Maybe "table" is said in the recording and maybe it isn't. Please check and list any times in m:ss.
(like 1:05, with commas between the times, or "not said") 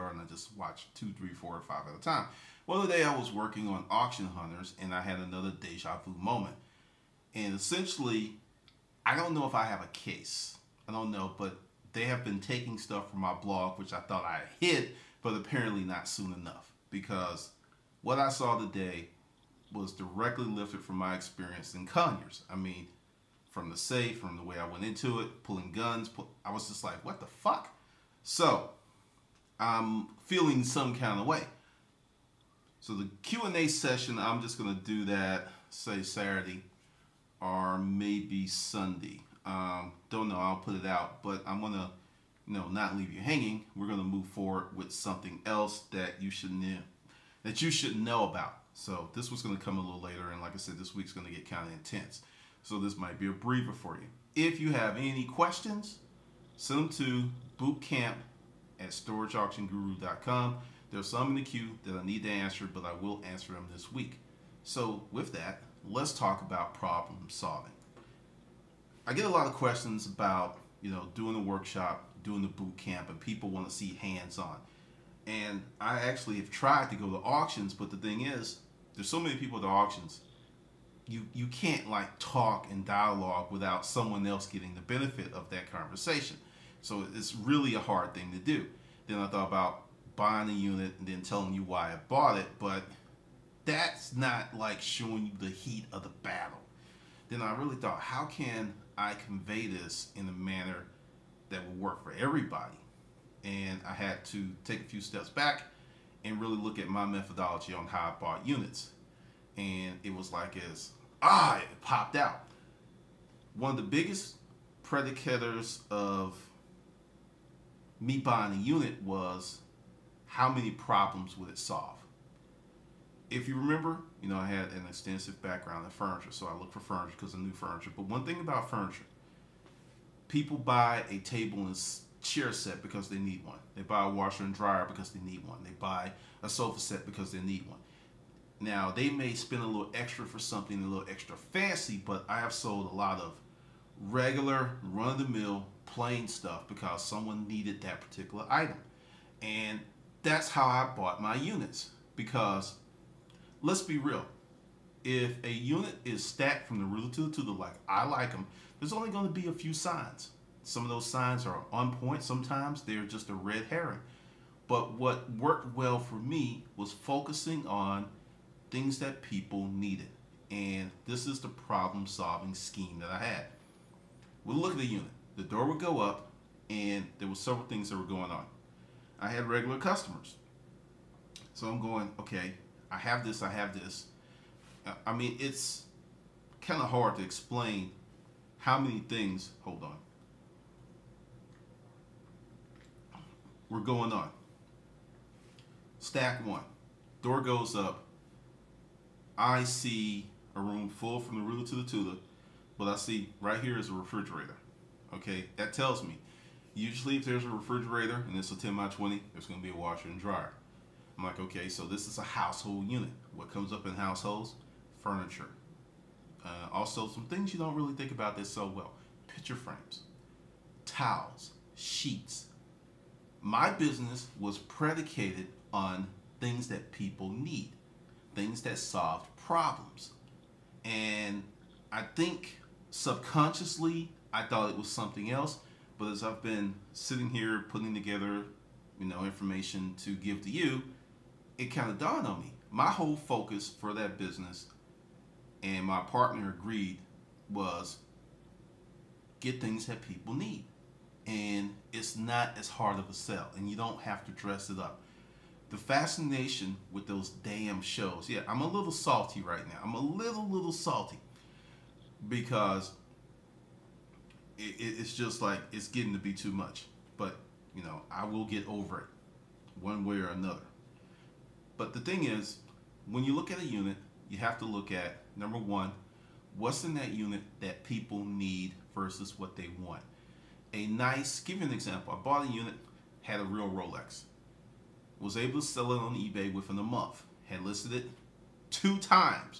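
2:11.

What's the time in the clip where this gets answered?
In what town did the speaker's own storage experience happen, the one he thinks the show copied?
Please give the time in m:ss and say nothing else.
0:21.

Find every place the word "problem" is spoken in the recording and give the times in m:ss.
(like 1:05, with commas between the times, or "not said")
1:06, 2:00, 2:51, 3:49.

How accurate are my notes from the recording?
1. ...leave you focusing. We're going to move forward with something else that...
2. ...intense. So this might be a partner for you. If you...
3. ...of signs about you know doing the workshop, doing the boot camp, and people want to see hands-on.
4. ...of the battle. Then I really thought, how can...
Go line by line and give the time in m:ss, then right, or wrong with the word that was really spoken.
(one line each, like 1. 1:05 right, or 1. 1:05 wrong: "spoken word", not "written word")
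1. 0:42 wrong: "hanging", not "focusing"
2. 0:51 wrong: "breather", not "partner"
3. 1:09 wrong: "questions", not "signs"
4. 1:35 right.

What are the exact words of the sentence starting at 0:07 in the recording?
And essentially, I don't know if I have a case.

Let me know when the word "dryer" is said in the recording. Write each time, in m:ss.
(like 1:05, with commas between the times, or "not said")
2:14, 3:30.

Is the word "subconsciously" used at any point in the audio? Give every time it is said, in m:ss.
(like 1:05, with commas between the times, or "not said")
3:52.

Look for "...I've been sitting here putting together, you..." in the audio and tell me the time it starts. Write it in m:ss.
3:56.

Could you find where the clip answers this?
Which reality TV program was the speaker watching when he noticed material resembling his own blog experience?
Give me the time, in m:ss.
0:03.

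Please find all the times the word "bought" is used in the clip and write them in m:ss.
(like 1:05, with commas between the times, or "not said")
1:32, 1:48, 2:30, 4:42.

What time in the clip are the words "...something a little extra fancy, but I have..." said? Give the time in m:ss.
2:20.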